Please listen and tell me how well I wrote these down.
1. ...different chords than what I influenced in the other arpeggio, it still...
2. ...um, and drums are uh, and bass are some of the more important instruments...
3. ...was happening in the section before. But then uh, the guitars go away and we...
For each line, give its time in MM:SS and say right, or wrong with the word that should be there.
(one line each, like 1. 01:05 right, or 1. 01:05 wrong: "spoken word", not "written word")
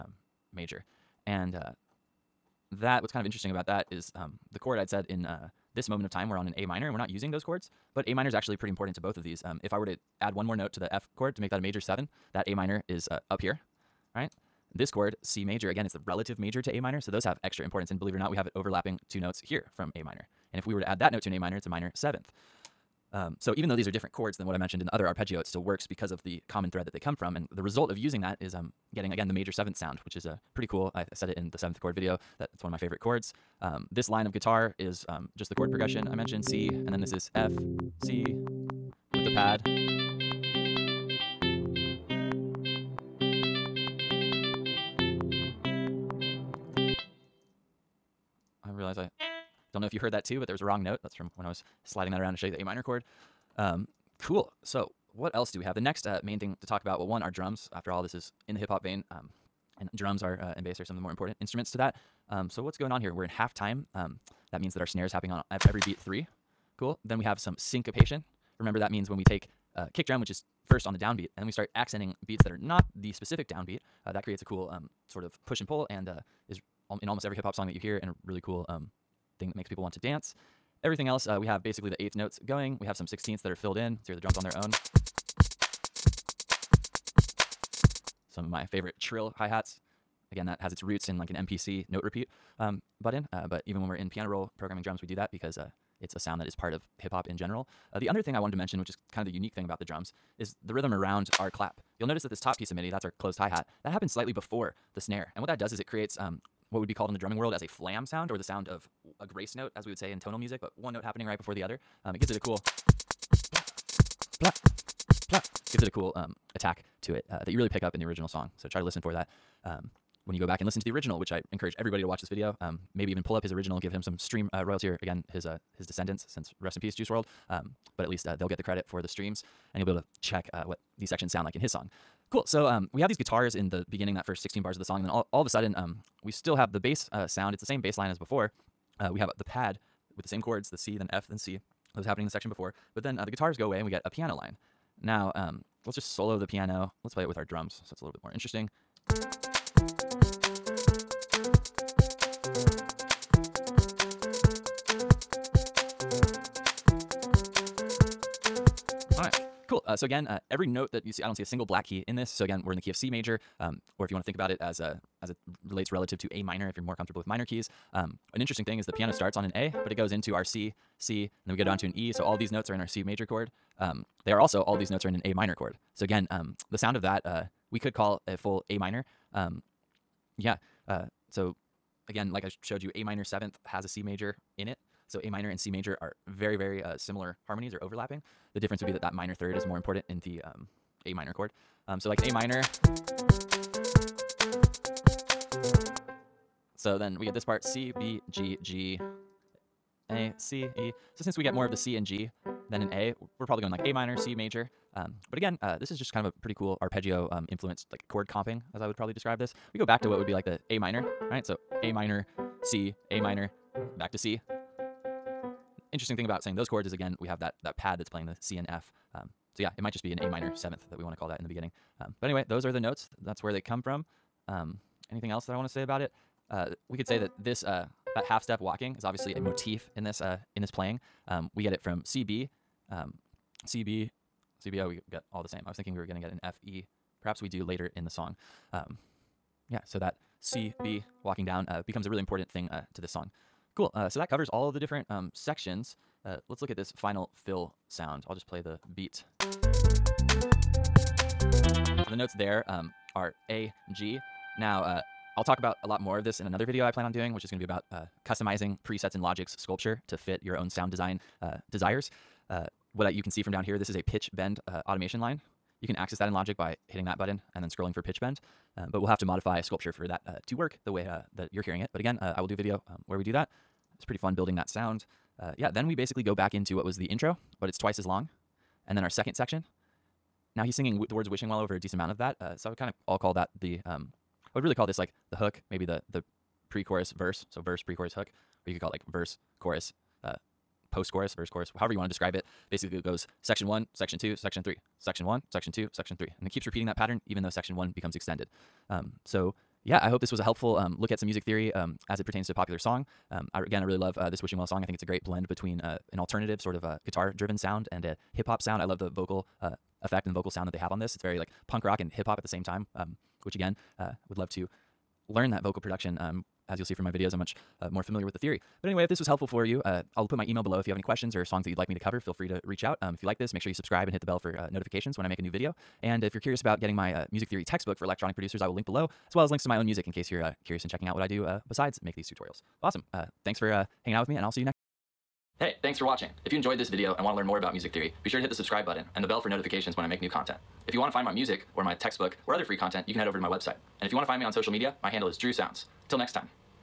1. 00:23 wrong: "mentioned", not "influenced"
2. 00:59 right
3. 02:21 right.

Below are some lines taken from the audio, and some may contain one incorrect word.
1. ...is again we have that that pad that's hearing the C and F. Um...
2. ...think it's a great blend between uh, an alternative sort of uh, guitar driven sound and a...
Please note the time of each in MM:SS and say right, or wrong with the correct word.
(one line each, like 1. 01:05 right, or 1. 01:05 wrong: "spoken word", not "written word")
1. 03:36 wrong: "playing", not "hearing"
2. 05:04 right.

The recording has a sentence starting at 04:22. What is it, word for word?
Uh, what I, you can see from down here, this is a pitch bend uh, automation line.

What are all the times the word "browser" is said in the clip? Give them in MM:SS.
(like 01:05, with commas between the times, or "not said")
not said.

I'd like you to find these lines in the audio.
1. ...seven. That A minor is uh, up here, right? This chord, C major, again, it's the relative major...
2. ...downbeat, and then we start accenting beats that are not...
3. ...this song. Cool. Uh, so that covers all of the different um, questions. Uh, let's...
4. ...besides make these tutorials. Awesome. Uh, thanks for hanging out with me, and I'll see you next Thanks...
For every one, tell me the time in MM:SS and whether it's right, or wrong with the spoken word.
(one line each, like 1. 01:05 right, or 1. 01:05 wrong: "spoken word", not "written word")
1. 00:11 right
2. 01:10 right
3. 04:03 wrong: "sections", not "questions"
4. 05:31 right.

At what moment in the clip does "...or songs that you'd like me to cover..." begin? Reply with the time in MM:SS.
05:21.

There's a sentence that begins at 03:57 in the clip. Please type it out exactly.
Perhaps we do later in the song.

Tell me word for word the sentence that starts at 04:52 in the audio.
Basically, it goes section one, section two, section three, section one, section two, section three.